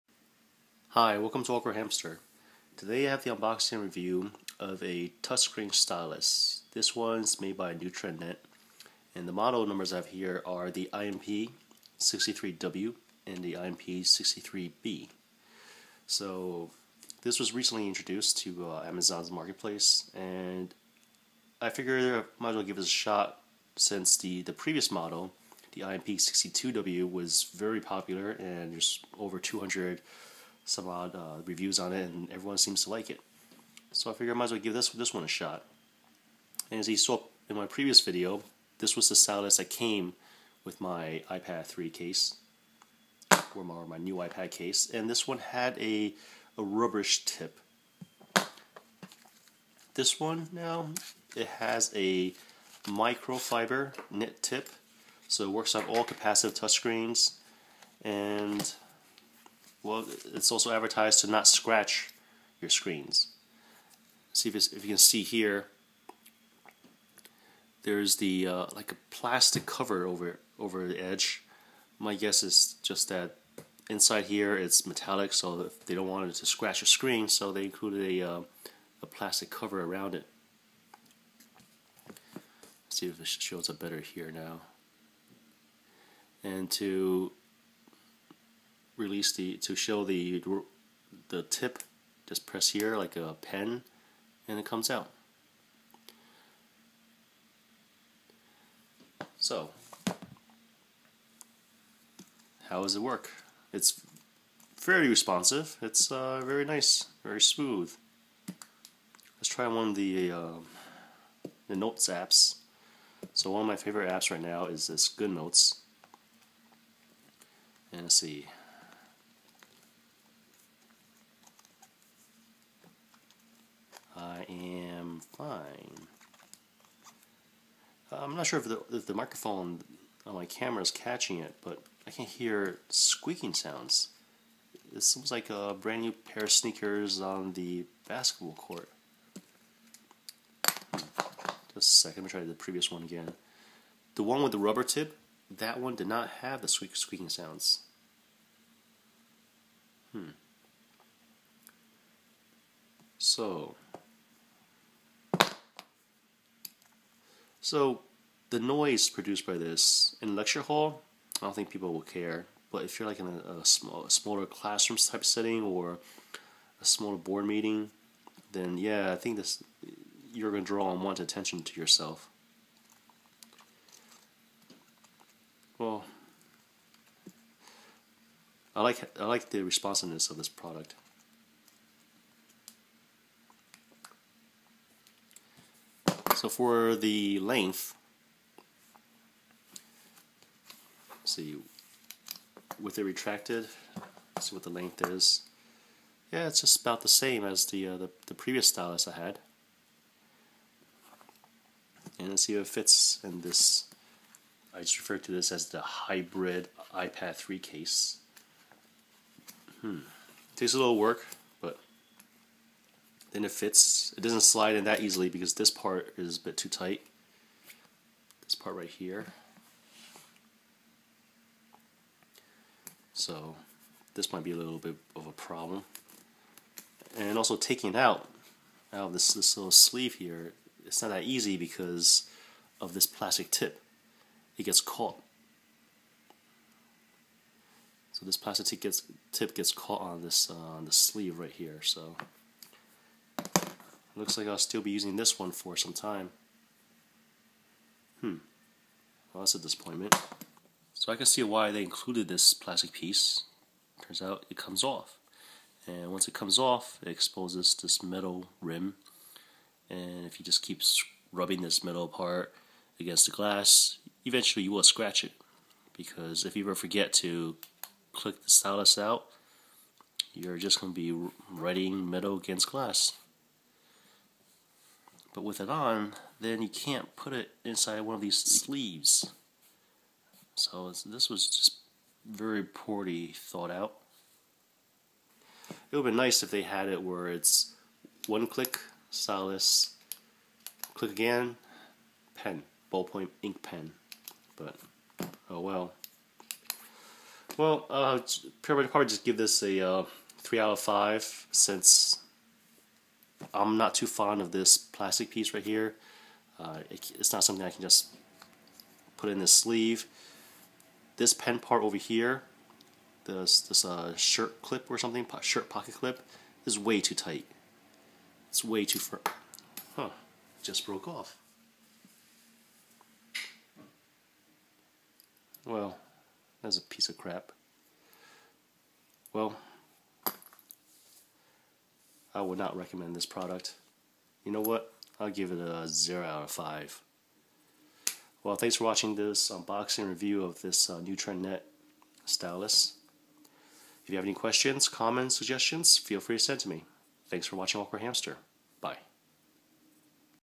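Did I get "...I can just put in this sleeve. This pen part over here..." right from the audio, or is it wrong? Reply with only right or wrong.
right.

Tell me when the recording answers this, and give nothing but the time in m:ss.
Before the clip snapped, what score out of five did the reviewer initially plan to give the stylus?
5:00.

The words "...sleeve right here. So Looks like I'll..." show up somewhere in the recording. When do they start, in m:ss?
4:00.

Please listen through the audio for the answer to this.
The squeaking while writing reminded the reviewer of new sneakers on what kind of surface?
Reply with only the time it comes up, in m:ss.
2:18.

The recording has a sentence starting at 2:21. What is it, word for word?
Just a second, let me try the previous one again.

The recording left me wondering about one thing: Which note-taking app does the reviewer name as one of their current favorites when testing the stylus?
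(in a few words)
GoodNotes.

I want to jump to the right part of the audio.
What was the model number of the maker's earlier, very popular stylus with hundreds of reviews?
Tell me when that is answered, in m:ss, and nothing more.
0:25.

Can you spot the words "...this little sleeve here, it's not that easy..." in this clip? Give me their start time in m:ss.
3:49.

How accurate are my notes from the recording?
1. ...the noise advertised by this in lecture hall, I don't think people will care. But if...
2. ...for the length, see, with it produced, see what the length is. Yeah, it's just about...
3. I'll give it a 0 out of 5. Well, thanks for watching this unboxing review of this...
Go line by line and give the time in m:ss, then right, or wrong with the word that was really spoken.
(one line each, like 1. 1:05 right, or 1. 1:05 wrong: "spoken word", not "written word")
1. 2:38 wrong: "produced", not "advertised"
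2. 3:06 wrong: "retracted", not "produced"
3. 5:35 right.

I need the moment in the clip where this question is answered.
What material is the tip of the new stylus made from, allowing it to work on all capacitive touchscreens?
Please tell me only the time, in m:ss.
0:52.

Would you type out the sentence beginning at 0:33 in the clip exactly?
So I figure I might as well give this this one a shot.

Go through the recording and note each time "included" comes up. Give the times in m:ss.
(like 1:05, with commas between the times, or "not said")
1:17, 4:11.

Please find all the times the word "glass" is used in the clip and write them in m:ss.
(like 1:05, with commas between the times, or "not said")
4:23, 4:32.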